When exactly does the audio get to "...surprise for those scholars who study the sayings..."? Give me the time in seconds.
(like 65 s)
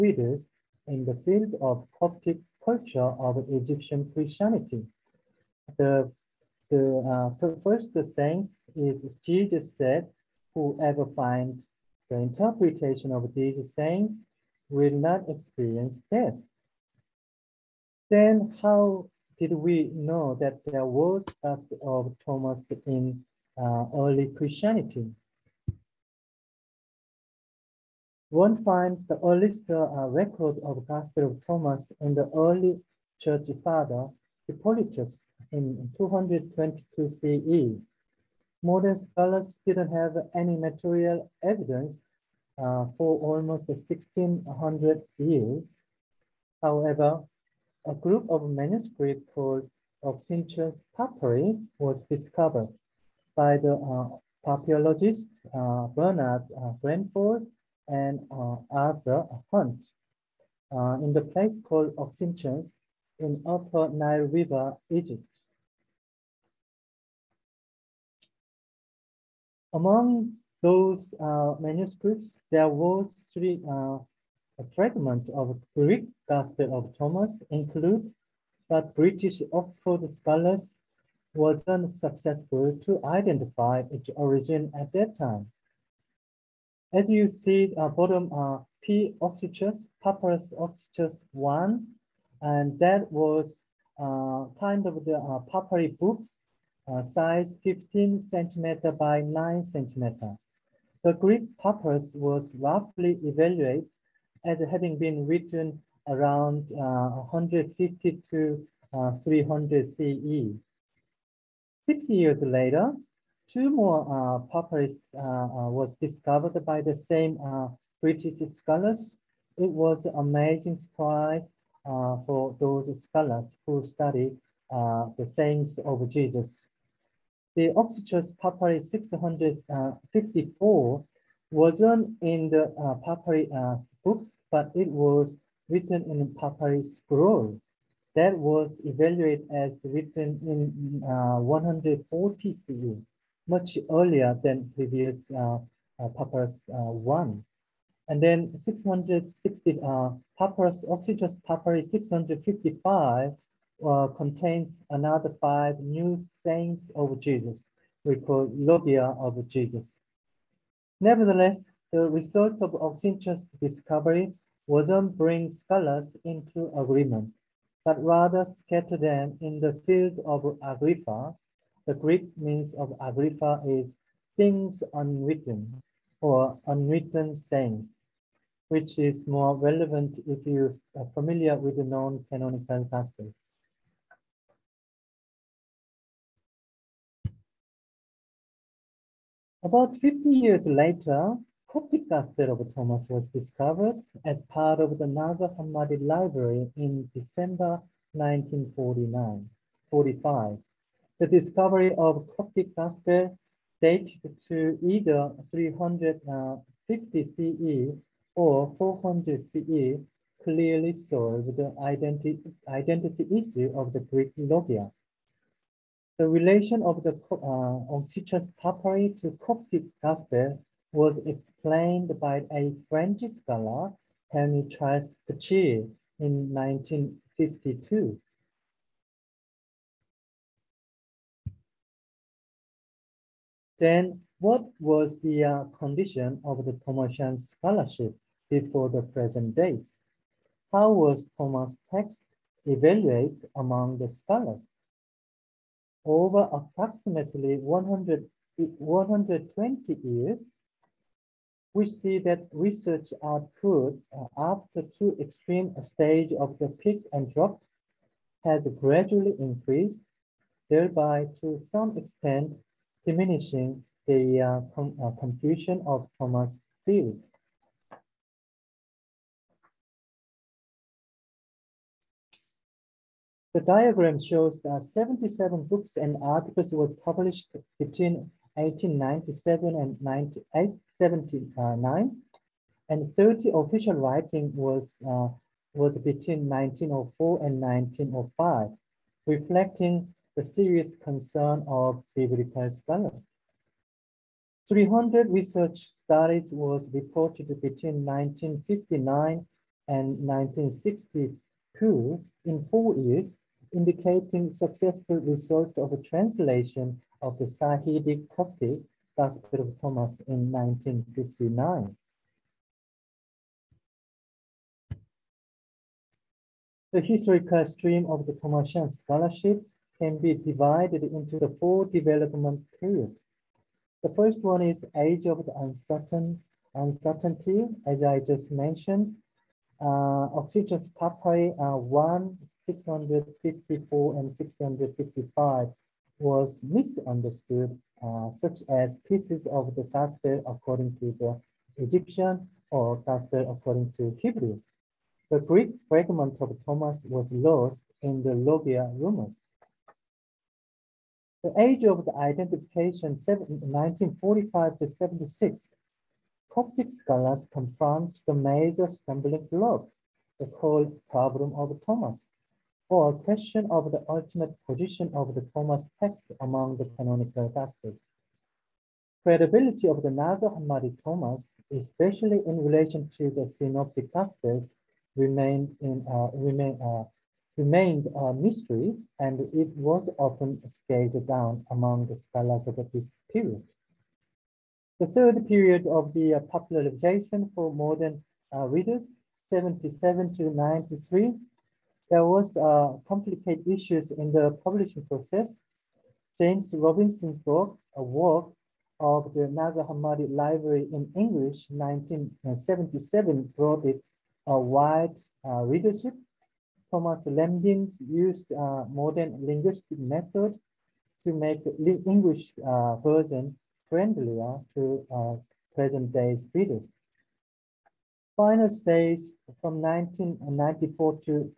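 120 s.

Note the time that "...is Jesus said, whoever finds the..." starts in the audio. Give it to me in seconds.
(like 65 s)
8 s.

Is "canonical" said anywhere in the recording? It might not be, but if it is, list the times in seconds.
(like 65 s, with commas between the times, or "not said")
182 s, 366 s.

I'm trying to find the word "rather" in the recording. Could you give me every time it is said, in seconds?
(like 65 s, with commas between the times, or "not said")
168 s.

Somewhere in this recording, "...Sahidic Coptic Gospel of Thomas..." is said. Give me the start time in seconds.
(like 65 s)
307 s.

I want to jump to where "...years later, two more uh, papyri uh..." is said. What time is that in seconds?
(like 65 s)
112 s.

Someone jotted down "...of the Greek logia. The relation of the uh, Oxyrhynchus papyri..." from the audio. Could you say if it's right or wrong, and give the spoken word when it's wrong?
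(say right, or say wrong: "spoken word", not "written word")
right.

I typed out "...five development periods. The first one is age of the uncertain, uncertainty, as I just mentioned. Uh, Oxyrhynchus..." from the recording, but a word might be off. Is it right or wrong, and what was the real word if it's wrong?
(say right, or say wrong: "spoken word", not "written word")
wrong: "four", not "five".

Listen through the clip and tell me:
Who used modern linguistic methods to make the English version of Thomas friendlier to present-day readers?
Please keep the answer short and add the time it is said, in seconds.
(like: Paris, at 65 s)
Thomas Lambdin, at 406 s.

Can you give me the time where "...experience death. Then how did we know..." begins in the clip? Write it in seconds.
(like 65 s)
15 s.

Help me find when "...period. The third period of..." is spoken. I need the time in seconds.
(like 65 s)
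383 s.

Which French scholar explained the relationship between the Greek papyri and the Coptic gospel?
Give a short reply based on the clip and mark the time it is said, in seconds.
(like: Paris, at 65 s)
Henry Charles Pachy, at 224 s.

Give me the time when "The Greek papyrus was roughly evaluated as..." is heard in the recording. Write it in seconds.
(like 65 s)
101 s.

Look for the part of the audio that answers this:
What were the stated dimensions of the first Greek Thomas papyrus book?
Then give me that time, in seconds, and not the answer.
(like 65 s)
97 s.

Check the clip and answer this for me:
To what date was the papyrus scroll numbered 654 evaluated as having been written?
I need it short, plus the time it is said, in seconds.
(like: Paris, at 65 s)
140 CE, at 141 s.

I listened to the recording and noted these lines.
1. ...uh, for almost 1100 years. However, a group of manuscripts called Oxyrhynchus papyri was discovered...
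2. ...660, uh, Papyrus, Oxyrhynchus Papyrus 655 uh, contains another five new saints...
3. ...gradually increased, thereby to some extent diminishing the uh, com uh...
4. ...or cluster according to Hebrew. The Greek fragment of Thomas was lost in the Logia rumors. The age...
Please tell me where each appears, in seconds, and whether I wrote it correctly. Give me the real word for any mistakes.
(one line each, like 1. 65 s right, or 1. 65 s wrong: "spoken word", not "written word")
1. 42 s wrong: "1600", not "1100"
2. 148 s right
3. 258 s right
4. 342 s right.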